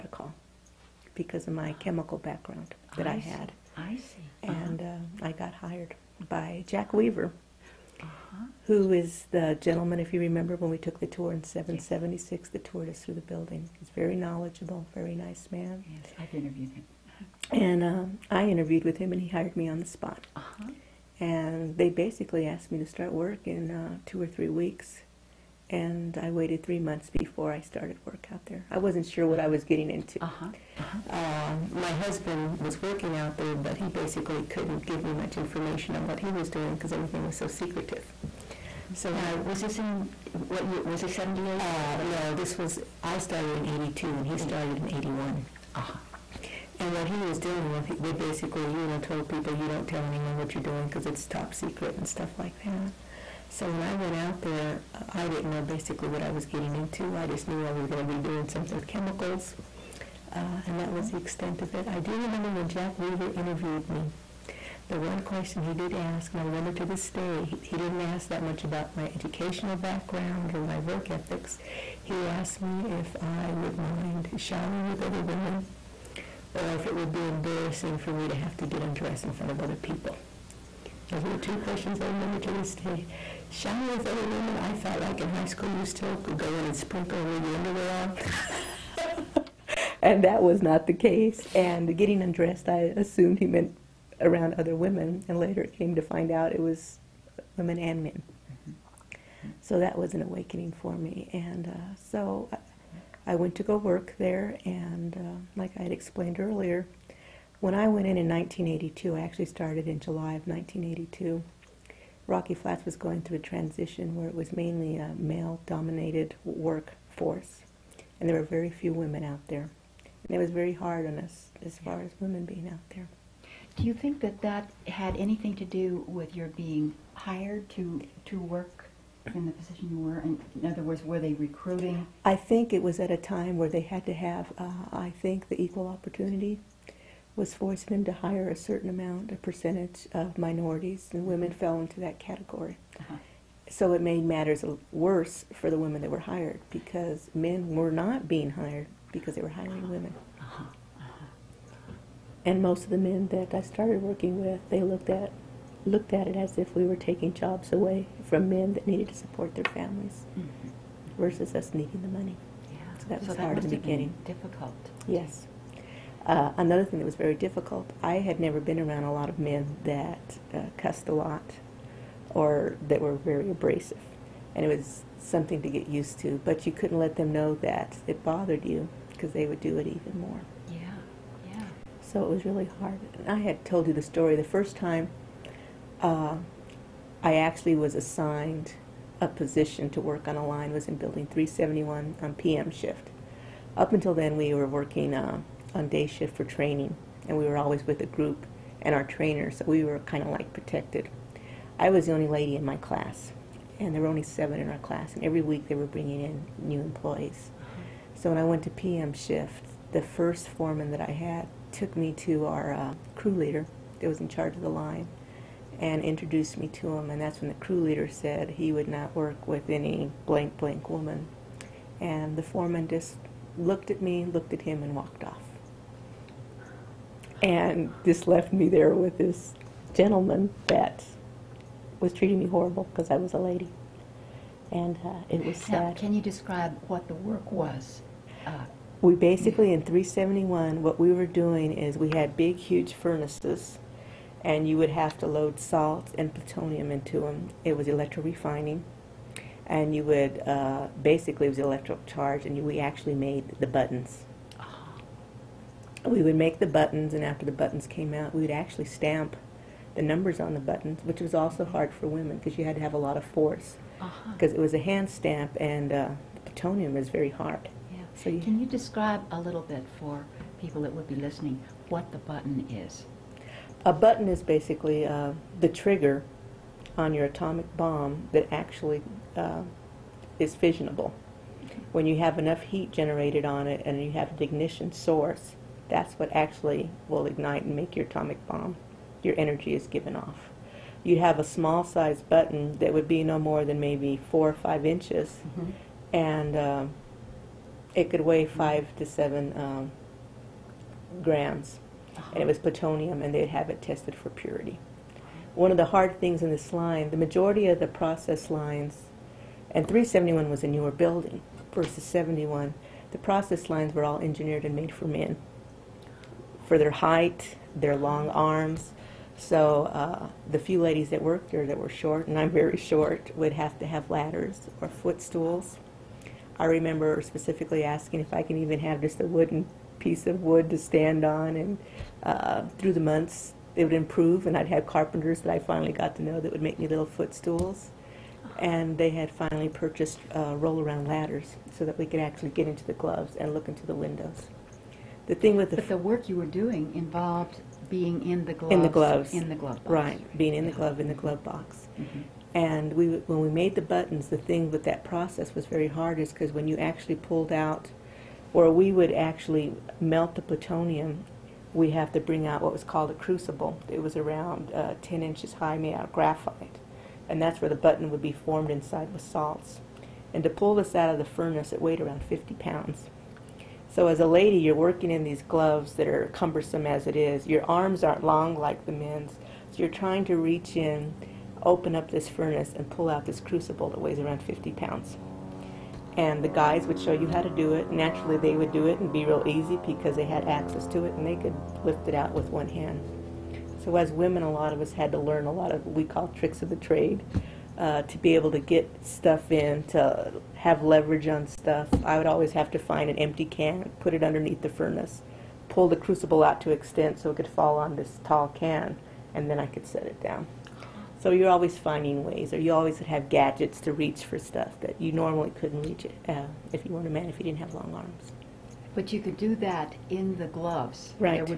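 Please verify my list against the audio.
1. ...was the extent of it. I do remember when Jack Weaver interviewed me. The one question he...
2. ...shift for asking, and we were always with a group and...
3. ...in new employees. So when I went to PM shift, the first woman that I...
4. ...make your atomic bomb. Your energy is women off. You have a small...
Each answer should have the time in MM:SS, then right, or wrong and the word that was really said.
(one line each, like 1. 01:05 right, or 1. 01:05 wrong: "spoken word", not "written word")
1. 01:00 right
2. 03:16 wrong: "training", not "asking"
3. 03:26 wrong: "foreman", not "woman"
4. 04:47 wrong: "given", not "women".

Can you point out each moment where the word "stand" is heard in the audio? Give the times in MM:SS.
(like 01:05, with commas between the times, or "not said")
05:30.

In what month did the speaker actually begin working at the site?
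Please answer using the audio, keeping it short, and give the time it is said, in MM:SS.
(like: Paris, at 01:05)
July, at 01:49.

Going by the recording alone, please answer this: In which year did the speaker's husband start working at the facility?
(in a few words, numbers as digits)
1981.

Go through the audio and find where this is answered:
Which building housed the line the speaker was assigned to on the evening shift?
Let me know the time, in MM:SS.
03:10.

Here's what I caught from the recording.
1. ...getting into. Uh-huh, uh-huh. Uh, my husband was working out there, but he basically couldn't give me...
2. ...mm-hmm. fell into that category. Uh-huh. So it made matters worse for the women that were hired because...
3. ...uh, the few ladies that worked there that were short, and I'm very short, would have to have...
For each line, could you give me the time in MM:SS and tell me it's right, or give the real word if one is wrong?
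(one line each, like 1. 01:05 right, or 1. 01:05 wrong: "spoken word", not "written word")
1. 00:29 right
2. 02:21 right
3. 05:19 right.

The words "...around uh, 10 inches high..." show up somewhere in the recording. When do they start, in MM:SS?
06:04.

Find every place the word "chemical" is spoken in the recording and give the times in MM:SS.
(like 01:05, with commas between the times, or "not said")
00:01, 00:58.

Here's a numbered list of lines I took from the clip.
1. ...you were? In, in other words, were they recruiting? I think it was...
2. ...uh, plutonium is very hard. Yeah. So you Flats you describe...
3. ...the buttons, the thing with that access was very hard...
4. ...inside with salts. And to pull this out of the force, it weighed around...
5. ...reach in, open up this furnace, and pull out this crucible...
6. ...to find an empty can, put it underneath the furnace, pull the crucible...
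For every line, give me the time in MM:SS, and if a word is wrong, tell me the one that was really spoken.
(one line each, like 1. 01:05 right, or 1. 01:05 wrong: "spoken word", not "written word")
1. 02:09 right
2. 04:25 wrong: "Can", not "Flats"
3. 05:53 wrong: "process", not "access"
4. 06:08 wrong: "furnace", not "force"
5. 06:20 right
6. 06:42 right.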